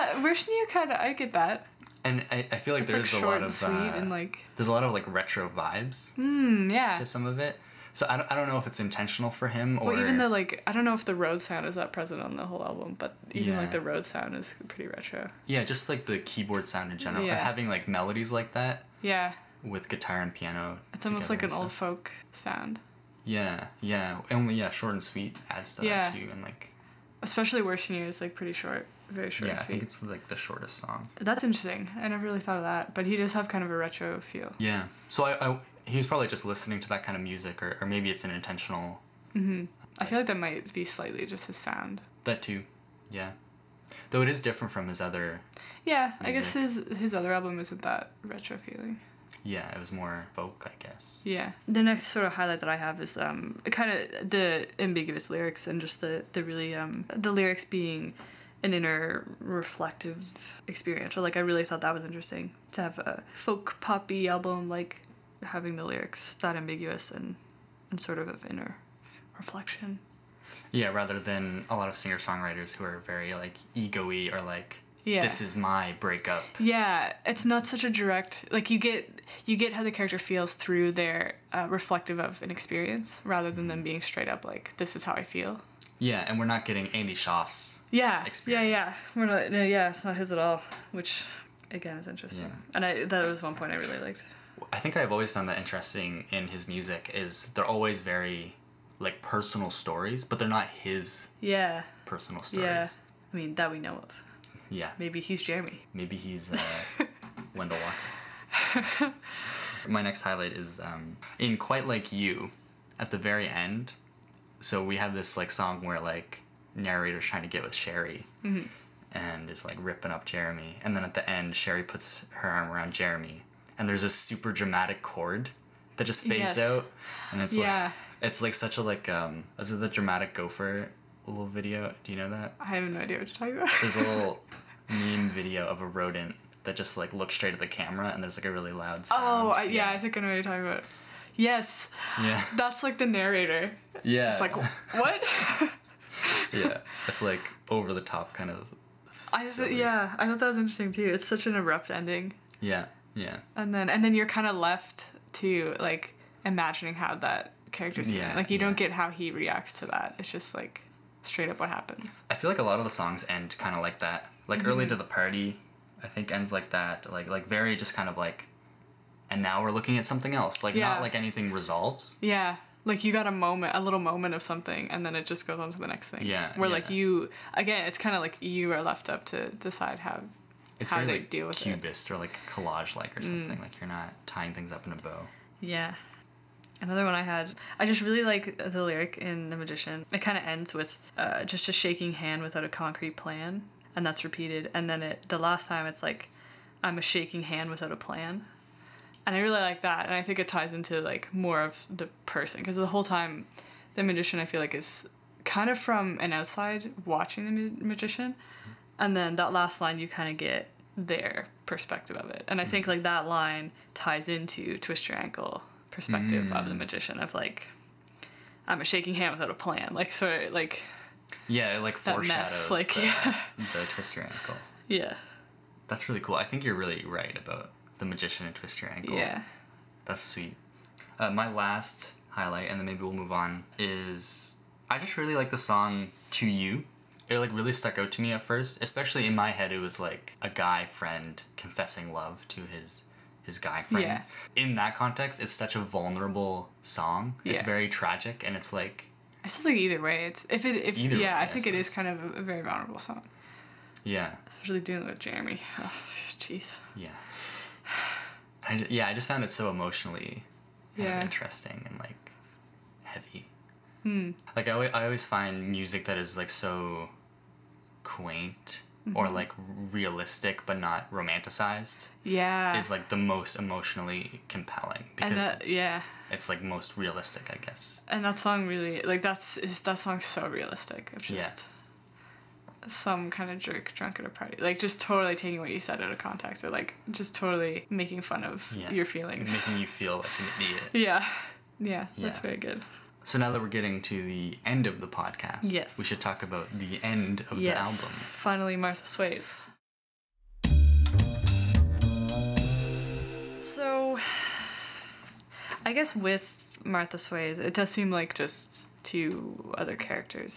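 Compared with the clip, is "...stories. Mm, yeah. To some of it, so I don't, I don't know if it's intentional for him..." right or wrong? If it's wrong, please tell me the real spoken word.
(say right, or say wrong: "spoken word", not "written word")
wrong: "vibes", not "stories".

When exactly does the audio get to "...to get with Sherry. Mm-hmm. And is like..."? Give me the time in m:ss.
1:57.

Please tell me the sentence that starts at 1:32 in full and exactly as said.
and I that was one point I really liked.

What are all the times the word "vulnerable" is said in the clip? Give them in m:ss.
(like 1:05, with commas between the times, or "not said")
4:05, 4:12.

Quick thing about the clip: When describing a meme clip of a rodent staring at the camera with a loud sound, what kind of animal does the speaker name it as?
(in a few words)
gopher.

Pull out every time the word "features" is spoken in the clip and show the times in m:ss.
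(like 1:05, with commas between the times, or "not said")
not said.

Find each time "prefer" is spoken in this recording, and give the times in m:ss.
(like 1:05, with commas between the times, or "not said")
not said.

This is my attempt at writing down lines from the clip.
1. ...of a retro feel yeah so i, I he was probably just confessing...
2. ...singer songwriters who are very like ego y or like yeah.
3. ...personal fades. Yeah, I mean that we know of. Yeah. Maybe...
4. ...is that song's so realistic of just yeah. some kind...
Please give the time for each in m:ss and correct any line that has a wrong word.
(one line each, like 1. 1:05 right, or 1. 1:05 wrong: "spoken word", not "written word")
1. 0:33 wrong: "listening", not "confessing"
2. 1:11 right
3. 1:42 wrong: "stories", not "fades"
4. 4:39 right.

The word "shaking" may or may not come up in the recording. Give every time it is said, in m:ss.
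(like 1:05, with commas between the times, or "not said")
3:11, 3:17, 3:38.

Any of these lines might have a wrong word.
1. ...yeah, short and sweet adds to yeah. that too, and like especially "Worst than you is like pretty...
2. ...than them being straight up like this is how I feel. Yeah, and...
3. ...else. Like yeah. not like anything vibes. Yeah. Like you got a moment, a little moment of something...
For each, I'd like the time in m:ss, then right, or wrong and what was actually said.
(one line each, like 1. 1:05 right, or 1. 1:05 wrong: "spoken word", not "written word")
1. 0:24 right
2. 1:23 right
3. 2:50 wrong: "resolves", not "vibes".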